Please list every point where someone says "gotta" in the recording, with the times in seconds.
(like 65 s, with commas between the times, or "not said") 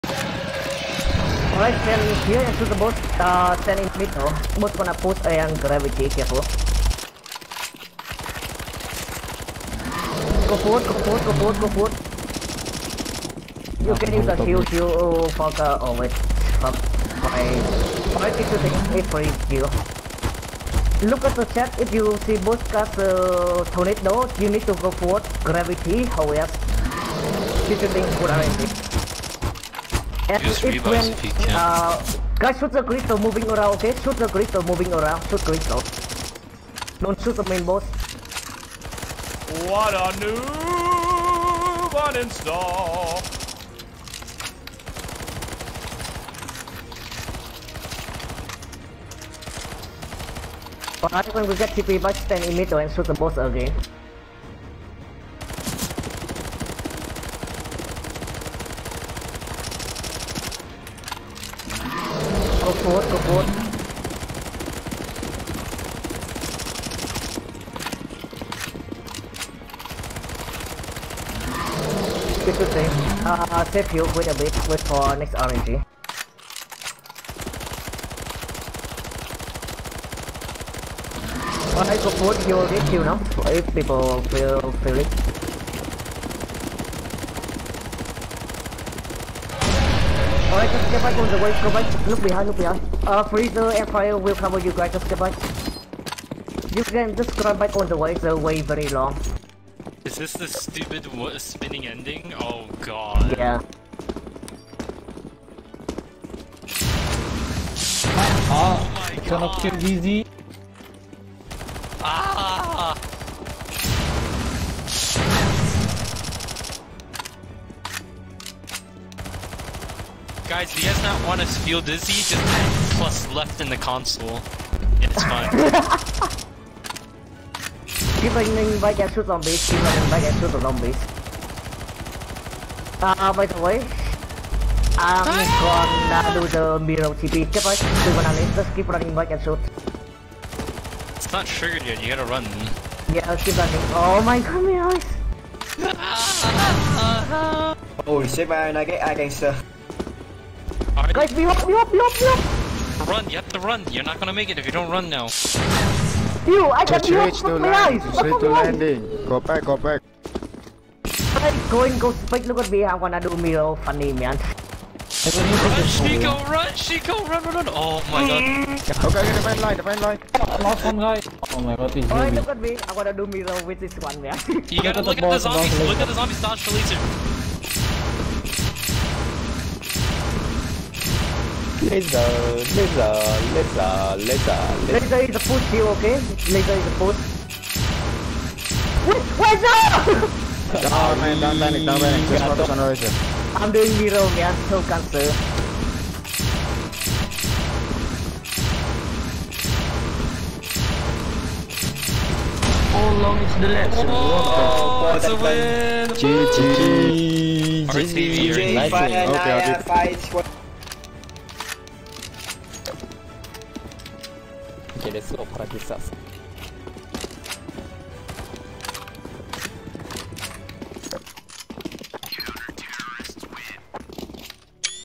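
142 s, 174 s.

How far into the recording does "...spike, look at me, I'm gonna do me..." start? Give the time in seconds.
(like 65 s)
162 s.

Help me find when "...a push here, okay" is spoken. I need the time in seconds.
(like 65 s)
185 s.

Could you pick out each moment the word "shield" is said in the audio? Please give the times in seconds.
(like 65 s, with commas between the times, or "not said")
14 s.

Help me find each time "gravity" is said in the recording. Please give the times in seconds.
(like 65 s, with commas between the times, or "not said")
5 s, 25 s.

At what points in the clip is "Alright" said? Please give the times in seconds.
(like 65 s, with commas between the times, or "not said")
1 s, 81 s, 90 s, 172 s.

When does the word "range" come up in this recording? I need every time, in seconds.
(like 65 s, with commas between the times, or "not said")
not said.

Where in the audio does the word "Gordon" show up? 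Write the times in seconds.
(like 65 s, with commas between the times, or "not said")
63 s.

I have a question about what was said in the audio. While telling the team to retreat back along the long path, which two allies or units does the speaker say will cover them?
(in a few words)
Freezer and Fire.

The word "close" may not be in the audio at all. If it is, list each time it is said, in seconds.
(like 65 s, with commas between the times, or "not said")
not said.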